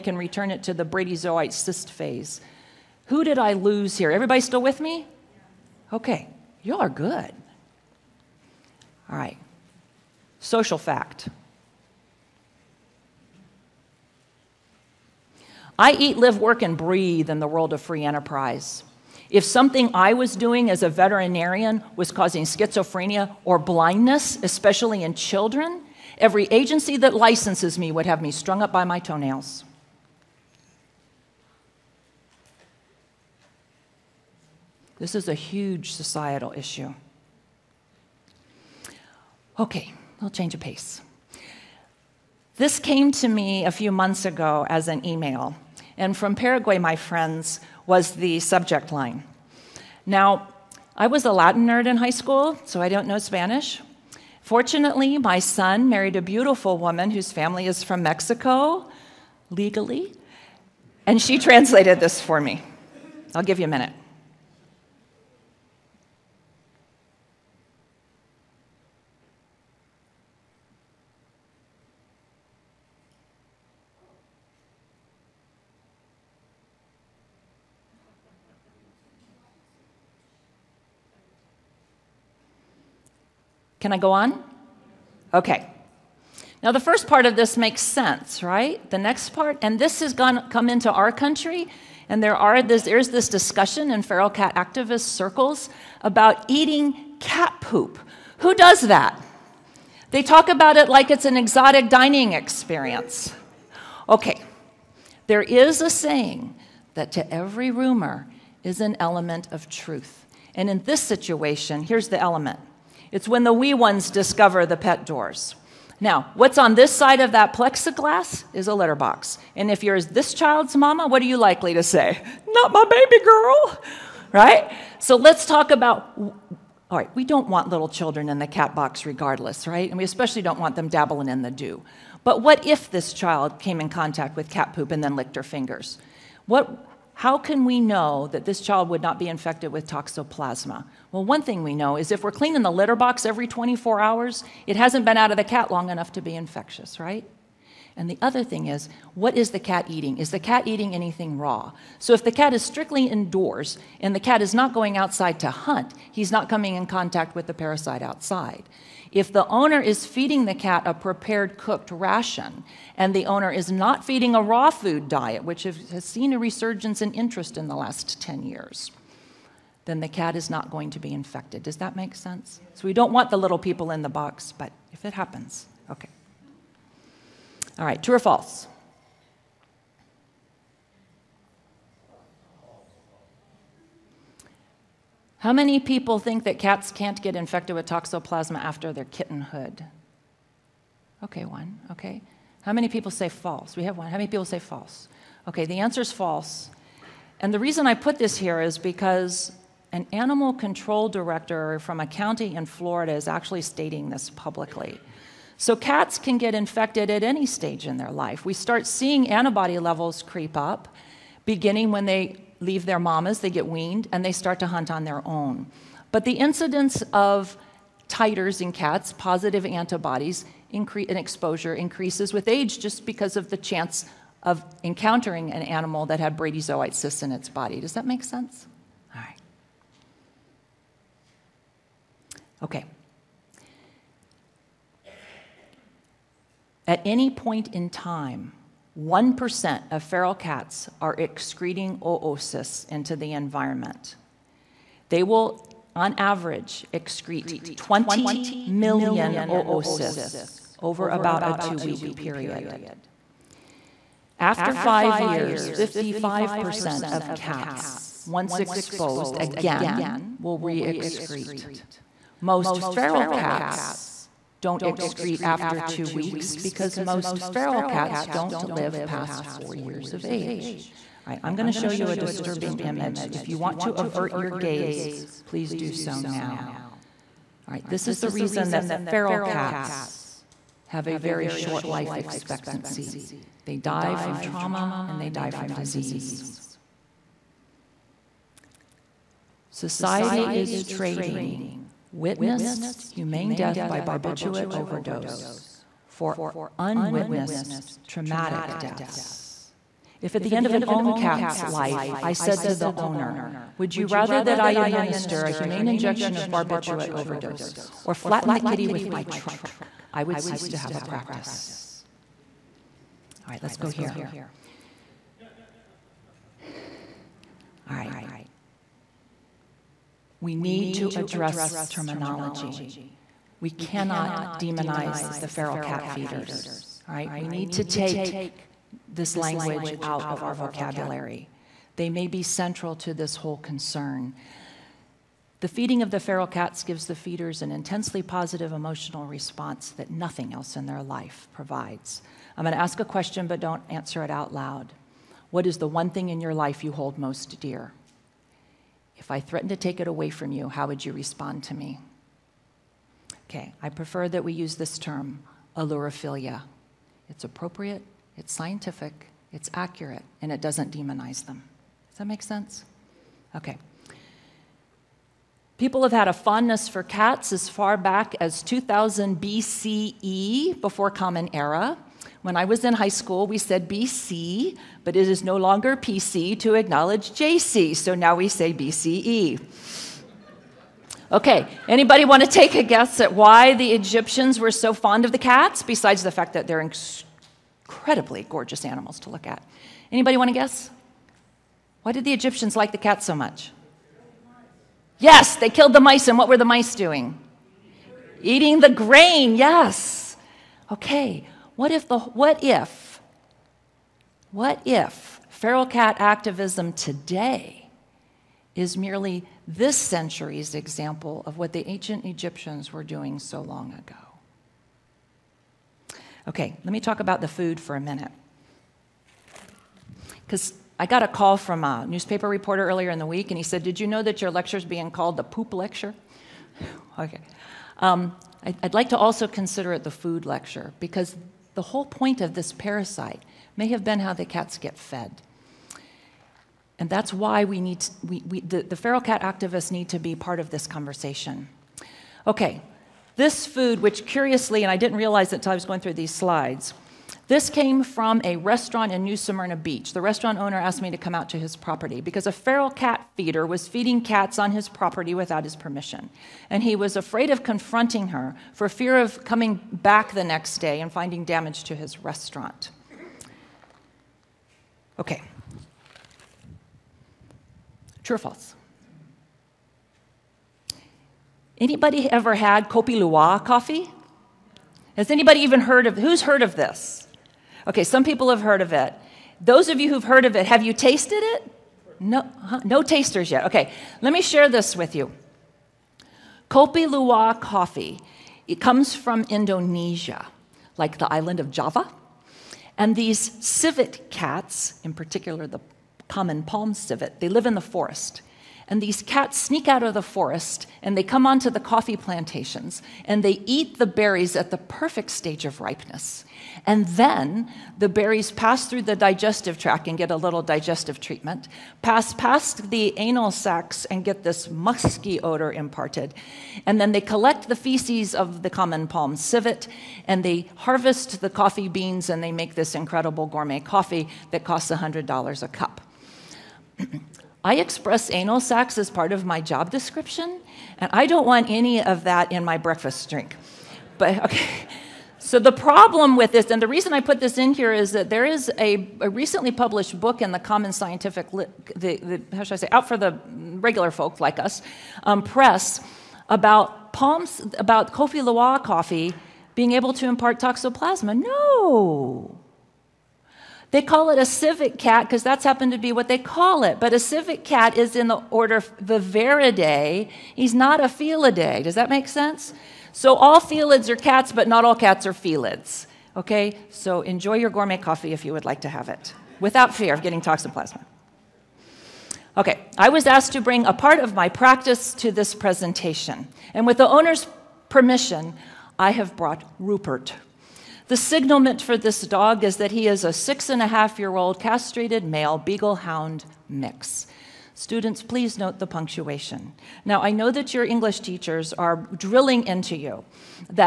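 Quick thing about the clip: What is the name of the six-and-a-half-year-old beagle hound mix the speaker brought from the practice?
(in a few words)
Rupert.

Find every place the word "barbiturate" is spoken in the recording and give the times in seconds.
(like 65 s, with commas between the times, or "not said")
294 s, 306 s.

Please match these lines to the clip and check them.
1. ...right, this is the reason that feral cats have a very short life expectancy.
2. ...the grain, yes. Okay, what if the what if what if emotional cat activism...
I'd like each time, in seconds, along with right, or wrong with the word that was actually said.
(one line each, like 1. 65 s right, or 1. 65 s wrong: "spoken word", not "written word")
1. 277 s right
2. 398 s wrong: "feral", not "emotional".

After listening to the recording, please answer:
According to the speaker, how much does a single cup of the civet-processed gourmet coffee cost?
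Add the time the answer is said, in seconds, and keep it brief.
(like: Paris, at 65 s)
$100, at 524 s.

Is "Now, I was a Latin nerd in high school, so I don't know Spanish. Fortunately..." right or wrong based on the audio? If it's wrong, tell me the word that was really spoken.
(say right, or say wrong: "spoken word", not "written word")
right.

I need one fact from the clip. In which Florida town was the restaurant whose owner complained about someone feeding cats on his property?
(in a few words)
New Smyrna Beach.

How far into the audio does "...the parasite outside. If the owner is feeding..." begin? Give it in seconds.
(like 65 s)
157 s.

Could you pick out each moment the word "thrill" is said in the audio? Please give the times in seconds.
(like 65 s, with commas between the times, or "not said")
not said.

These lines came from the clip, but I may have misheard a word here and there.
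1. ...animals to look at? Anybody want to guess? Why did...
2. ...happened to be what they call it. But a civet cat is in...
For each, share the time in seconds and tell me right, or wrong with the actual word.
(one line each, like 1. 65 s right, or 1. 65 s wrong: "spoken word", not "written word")
1. 388 s right
2. 555 s right.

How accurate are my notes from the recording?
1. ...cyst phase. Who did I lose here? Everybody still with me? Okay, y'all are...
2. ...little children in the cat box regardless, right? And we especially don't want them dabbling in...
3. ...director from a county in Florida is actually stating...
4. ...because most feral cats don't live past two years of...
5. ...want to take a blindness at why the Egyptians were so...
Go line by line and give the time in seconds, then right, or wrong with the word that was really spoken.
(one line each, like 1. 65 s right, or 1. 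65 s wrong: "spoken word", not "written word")
1. 1 s right
2. 127 s right
3. 201 s right
4. 266 s wrong: "four", not "two"
5. 382 s wrong: "guess", not "blindness".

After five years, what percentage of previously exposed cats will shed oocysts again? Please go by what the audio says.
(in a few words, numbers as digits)
55%.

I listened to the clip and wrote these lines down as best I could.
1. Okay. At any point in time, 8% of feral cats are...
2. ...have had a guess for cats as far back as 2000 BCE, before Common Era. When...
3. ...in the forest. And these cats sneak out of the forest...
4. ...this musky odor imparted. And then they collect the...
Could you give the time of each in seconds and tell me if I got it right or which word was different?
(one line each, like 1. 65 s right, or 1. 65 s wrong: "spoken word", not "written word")
1. 232 s wrong: "1", not "8"
2. 366 s wrong: "fondness", not "guess"
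3. 497 s right
4. 514 s right.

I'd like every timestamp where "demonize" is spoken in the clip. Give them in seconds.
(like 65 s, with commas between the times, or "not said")
324 s, 360 s.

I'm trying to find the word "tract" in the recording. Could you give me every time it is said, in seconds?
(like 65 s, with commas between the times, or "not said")
509 s.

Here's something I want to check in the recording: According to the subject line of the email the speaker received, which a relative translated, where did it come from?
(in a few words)
Paraguay.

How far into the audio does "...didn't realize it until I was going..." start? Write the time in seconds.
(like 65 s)
444 s.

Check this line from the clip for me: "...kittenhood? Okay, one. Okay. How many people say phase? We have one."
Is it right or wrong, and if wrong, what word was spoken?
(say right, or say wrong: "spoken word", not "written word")
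wrong: "false", not "phase".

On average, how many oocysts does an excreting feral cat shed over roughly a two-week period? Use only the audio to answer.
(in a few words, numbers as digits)
20 million.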